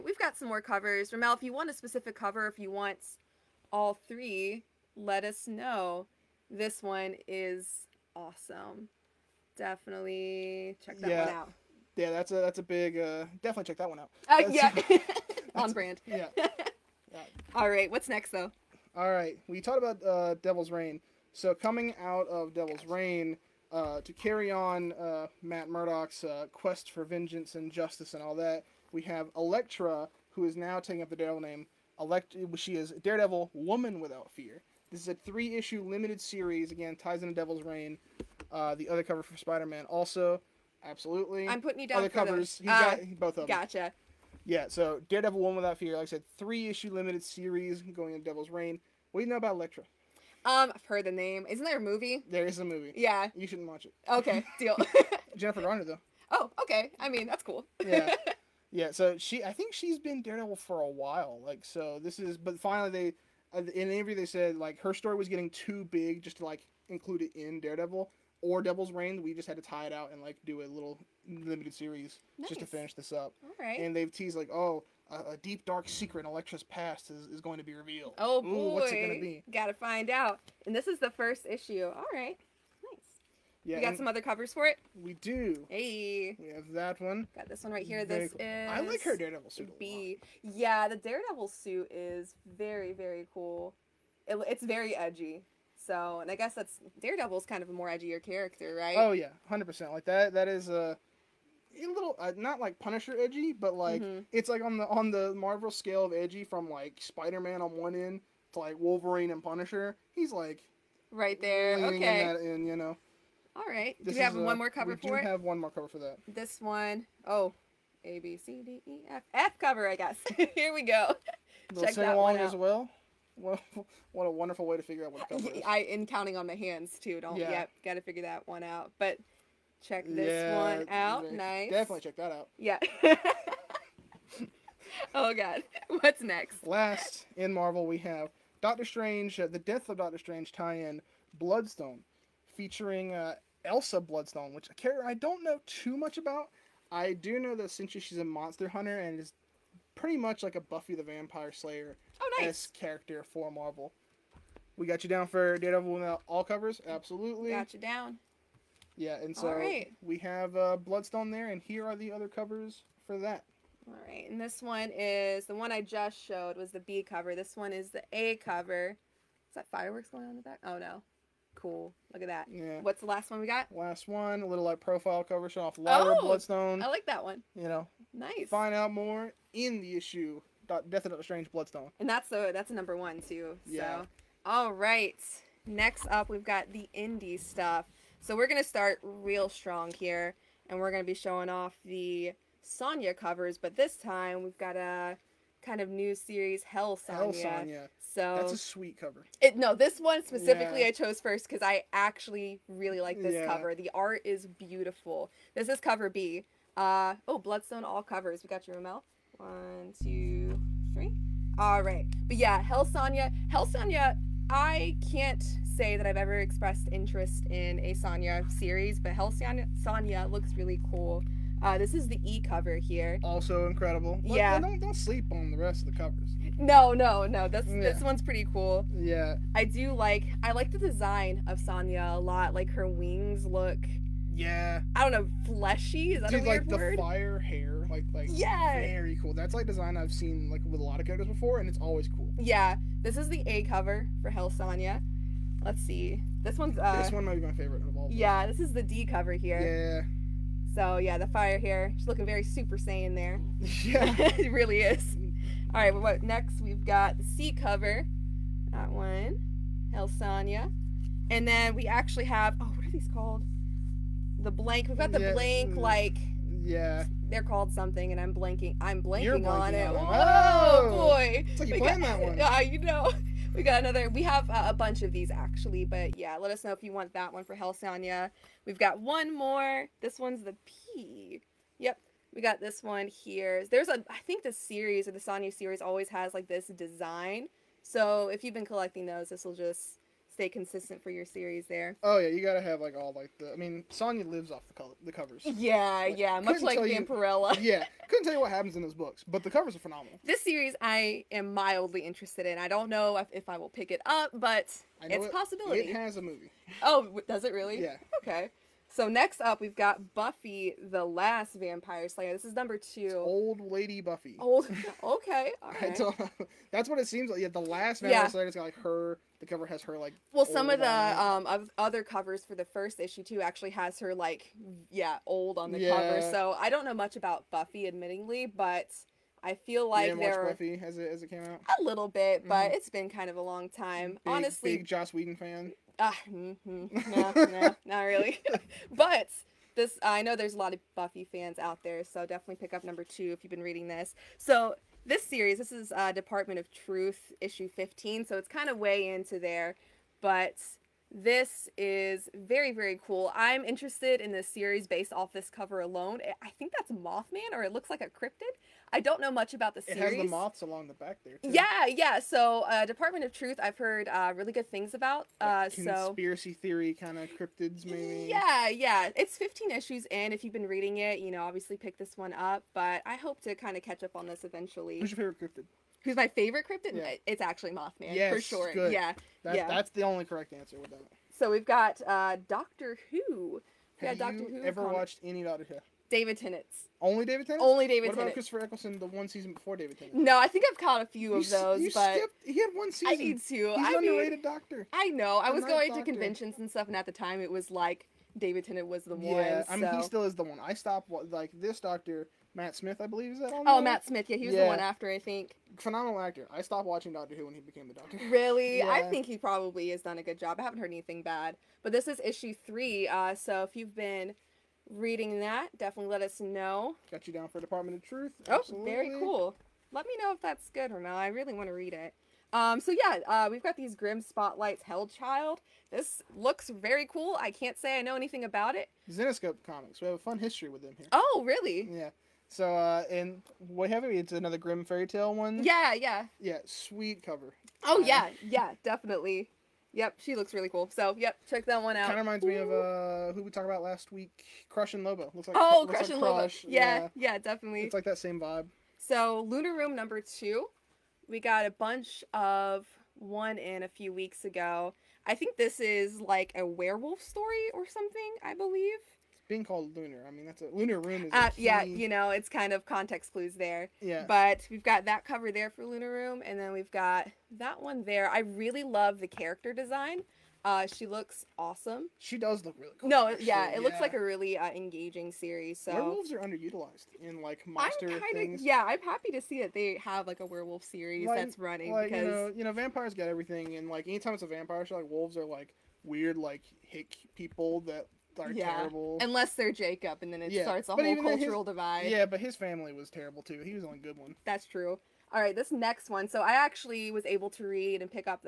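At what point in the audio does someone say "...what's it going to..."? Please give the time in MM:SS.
01:18.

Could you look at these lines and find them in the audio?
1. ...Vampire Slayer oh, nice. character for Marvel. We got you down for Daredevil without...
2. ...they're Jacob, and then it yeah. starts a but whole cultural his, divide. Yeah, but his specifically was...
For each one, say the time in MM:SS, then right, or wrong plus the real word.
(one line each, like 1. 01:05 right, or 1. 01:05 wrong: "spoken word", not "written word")
1. 02:31 right
2. 08:09 wrong: "family", not "specifically".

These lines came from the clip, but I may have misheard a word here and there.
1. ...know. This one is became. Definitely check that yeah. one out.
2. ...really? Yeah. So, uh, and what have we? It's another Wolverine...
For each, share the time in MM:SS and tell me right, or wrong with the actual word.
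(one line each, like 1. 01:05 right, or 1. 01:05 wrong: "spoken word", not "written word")
1. 00:05 wrong: "awesome", not "became"
2. 07:11 wrong: "Grimm", not "Wolverine".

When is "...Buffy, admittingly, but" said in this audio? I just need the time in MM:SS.
05:27.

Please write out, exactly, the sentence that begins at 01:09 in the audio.
We just had to tie it out and like do a little limited series nice.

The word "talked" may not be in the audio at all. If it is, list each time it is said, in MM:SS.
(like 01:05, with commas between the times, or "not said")
00:19, 07:23.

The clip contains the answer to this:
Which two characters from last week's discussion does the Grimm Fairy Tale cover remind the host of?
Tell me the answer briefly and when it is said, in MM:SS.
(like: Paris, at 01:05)
Crush and Lobo, at 07:24.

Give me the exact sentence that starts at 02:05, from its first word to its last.
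I in counting on my hands too.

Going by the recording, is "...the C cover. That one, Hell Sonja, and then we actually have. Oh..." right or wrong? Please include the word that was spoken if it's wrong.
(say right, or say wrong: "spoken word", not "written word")
right.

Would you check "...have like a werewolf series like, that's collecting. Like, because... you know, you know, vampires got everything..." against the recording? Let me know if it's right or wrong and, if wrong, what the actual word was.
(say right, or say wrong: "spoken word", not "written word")
wrong: "running", not "collecting".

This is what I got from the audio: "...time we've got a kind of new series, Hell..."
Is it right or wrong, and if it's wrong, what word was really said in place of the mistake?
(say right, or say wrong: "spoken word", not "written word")
right.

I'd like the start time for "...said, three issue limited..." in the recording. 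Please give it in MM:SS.
00:46.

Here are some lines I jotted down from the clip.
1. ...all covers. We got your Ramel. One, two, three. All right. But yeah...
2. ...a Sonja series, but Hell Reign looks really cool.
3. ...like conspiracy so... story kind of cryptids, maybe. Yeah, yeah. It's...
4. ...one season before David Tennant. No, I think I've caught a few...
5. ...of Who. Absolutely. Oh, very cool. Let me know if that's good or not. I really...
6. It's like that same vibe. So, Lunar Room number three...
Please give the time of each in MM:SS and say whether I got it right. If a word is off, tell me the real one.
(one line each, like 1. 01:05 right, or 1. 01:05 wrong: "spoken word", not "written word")
1. 03:27 right
2. 03:37 wrong: "Sonja", not "Reign"
3. 06:05 wrong: "theory", not "story"
4. 06:29 right
5. 06:57 wrong: "Truth", not "Who"
6. 07:27 wrong: "two", not "three".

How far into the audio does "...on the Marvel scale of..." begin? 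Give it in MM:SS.
01:44.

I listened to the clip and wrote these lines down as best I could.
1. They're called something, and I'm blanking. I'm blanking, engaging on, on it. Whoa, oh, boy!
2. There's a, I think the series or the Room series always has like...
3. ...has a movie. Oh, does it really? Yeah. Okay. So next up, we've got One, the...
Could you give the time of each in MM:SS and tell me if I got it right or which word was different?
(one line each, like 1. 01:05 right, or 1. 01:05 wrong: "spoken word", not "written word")
1. 04:27 wrong: "blanking", not "engaging"
2. 04:43 wrong: "Sonja", not "Room"
3. 05:05 wrong: "Buffy", not "One".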